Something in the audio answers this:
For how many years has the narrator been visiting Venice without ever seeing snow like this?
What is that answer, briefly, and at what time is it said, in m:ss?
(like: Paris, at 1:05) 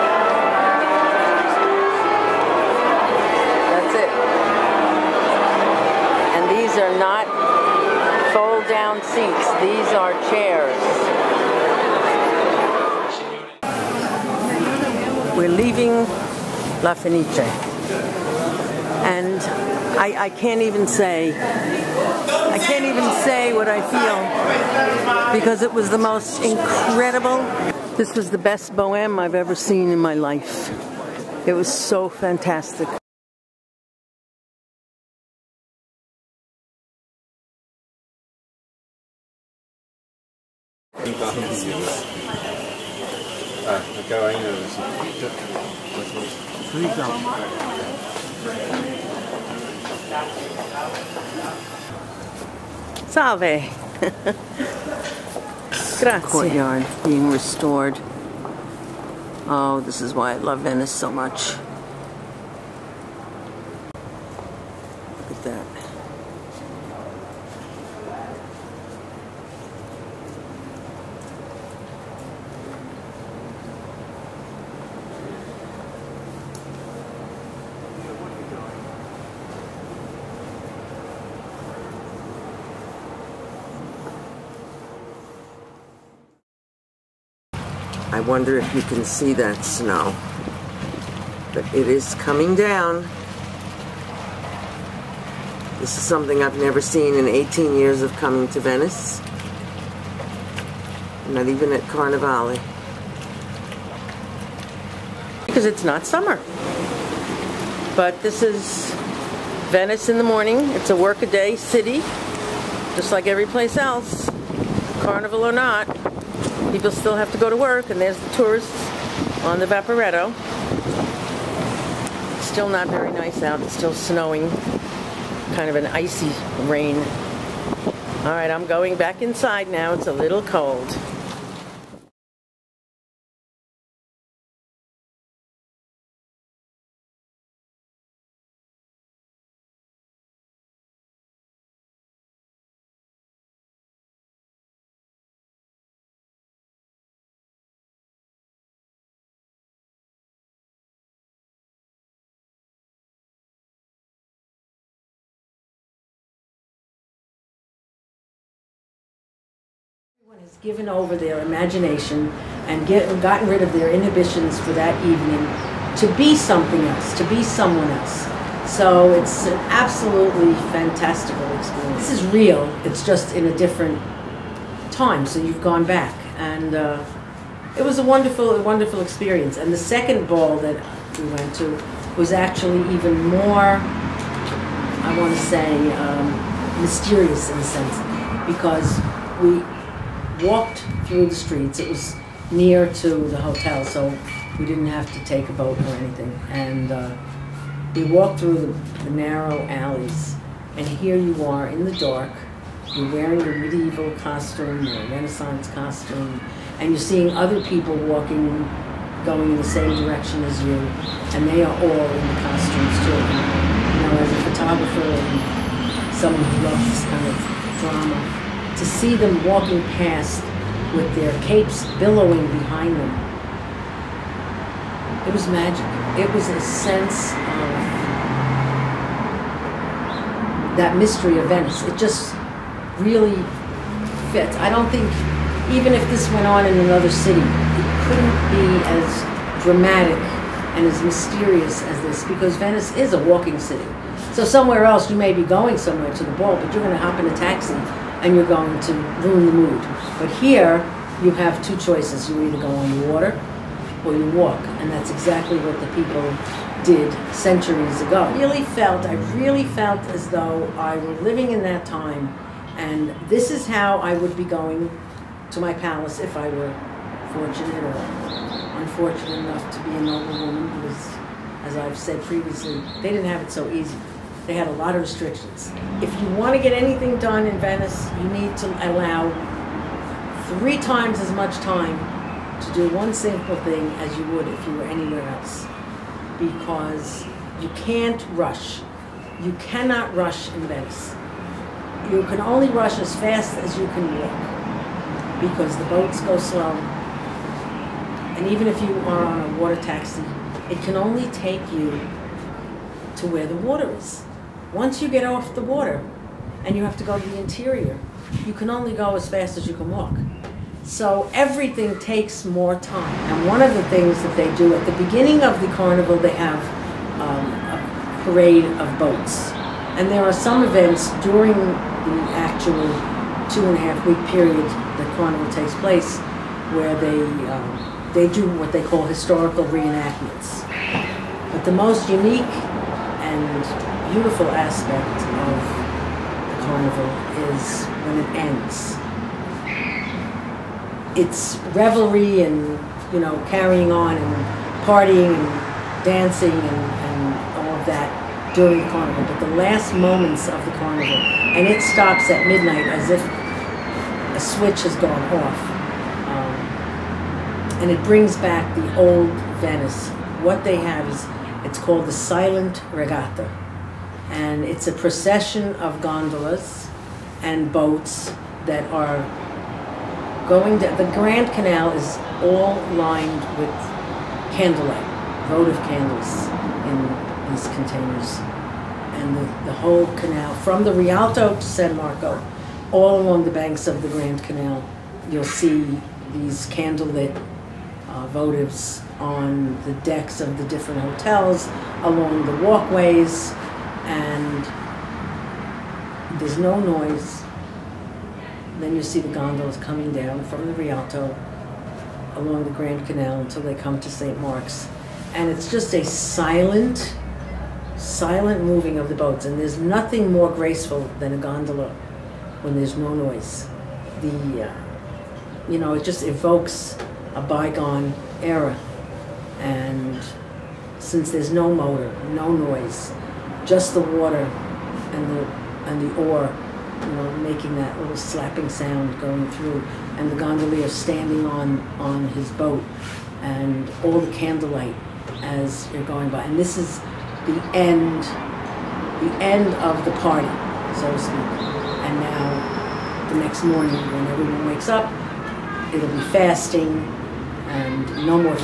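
18 years, at 1:37.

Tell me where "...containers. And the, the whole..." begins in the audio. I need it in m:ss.
6:17.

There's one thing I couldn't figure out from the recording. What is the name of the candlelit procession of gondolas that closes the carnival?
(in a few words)
Silent regatta.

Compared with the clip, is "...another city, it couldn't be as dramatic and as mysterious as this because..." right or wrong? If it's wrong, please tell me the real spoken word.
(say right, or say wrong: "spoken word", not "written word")
right.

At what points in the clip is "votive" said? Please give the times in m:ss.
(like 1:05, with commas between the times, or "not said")
6:15, 6:28.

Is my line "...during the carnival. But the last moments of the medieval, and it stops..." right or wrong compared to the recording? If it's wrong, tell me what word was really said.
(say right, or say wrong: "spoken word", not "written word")
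wrong: "carnival", not "medieval".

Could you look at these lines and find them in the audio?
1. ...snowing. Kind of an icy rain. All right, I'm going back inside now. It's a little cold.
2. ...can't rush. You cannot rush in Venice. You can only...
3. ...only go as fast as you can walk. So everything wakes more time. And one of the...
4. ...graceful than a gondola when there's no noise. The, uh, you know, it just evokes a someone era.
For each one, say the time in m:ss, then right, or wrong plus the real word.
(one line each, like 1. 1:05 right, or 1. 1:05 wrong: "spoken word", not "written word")
1. 2:03 right
2. 4:47 right
3. 5:08 wrong: "takes", not "wakes"
4. 6:50 wrong: "bygone", not "someone".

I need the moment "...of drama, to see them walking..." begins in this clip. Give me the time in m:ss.
3:37.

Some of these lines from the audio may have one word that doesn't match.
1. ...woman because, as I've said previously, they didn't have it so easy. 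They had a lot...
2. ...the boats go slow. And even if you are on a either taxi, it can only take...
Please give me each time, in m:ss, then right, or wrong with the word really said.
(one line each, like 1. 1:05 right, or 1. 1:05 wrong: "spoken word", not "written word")
1. 4:30 right
2. 4:55 wrong: "water", not "either".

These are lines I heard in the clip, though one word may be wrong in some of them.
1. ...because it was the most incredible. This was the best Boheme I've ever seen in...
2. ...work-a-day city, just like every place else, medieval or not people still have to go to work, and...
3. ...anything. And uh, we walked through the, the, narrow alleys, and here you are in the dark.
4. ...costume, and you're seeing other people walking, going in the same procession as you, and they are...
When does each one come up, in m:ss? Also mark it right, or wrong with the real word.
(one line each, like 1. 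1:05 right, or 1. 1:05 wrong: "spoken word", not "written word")
1. 0:25 right
2. 1:50 wrong: "carnival", not "medieval"
3. 3:15 right
4. 3:25 wrong: "direction", not "procession".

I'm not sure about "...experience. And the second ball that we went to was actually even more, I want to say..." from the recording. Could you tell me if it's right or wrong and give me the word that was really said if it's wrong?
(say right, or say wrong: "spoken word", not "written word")
right.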